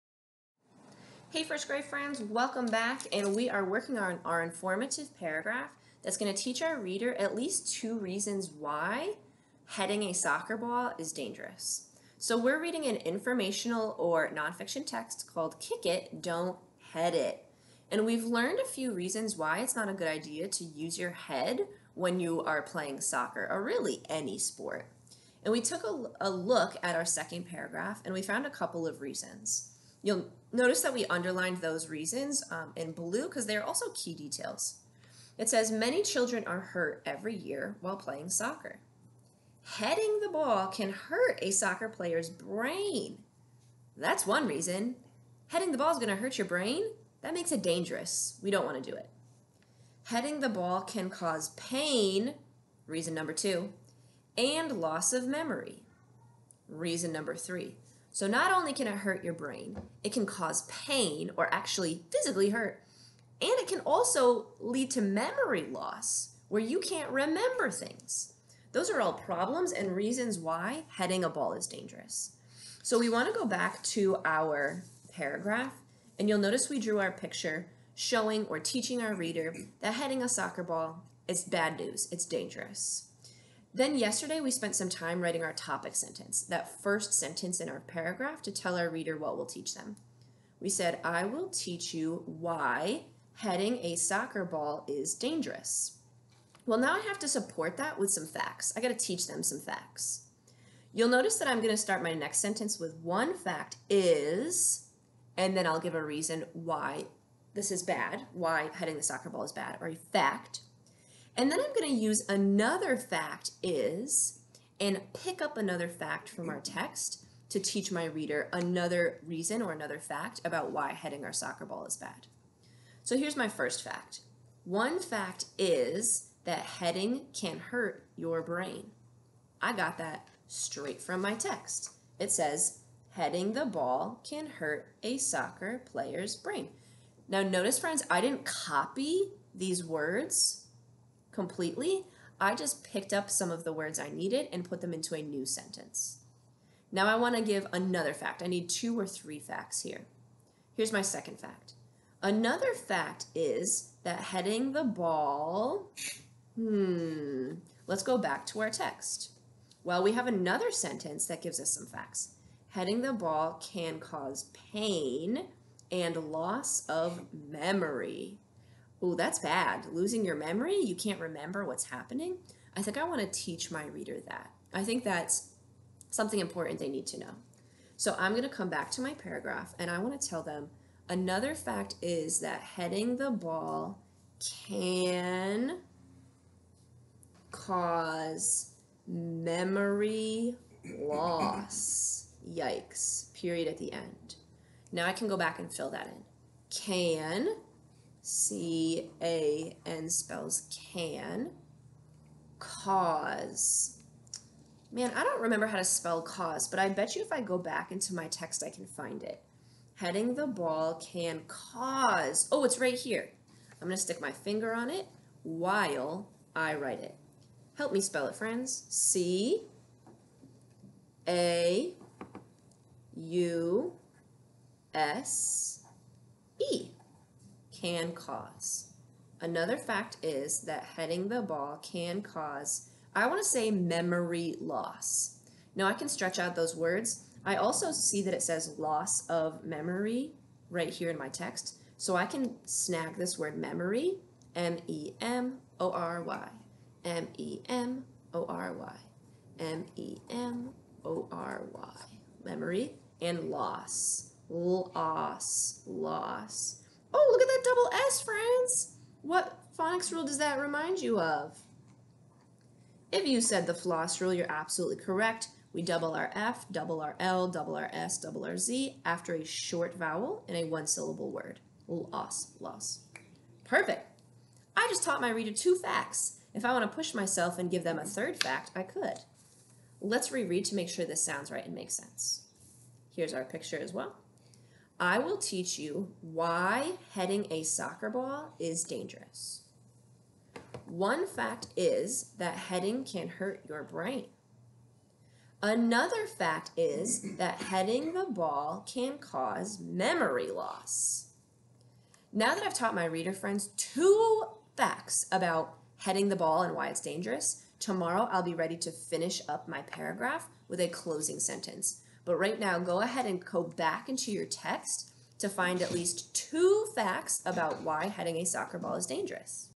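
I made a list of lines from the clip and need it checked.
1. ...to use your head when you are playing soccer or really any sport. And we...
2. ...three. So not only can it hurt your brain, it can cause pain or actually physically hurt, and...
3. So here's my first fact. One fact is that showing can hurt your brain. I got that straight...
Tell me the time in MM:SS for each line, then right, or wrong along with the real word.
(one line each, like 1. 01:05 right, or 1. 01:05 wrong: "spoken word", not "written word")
1. 00:20 right
2. 00:57 right
3. 02:03 wrong: "heading", not "showing".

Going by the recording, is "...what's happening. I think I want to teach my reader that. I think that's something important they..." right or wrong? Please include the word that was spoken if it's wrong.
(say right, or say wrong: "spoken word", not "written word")
right.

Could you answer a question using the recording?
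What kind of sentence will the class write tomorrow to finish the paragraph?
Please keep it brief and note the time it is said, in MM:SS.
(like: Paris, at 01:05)
closing sentence, at 05:10.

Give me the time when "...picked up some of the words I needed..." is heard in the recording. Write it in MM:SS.
02:22.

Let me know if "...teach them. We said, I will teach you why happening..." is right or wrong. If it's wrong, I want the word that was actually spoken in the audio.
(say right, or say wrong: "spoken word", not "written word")
wrong: "heading", not "happening".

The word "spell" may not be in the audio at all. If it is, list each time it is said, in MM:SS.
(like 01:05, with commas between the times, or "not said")
03:20, 03:25, 03:38.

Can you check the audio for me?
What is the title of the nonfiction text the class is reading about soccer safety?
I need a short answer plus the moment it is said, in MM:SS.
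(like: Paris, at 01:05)
Kick It, Don't Head It, at 00:15.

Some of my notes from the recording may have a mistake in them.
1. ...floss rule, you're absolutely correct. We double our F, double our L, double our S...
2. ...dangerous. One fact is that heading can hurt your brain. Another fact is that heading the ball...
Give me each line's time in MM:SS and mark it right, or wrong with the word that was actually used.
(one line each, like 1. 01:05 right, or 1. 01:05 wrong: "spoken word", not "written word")
1. 04:23 right
2. 04:48 right.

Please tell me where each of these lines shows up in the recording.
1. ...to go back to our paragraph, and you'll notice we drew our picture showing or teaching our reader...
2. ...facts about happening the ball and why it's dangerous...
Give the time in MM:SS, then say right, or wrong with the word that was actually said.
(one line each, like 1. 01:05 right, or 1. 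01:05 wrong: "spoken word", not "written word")
1. 01:13 right
2. 05:04 wrong: "heading", not "happening".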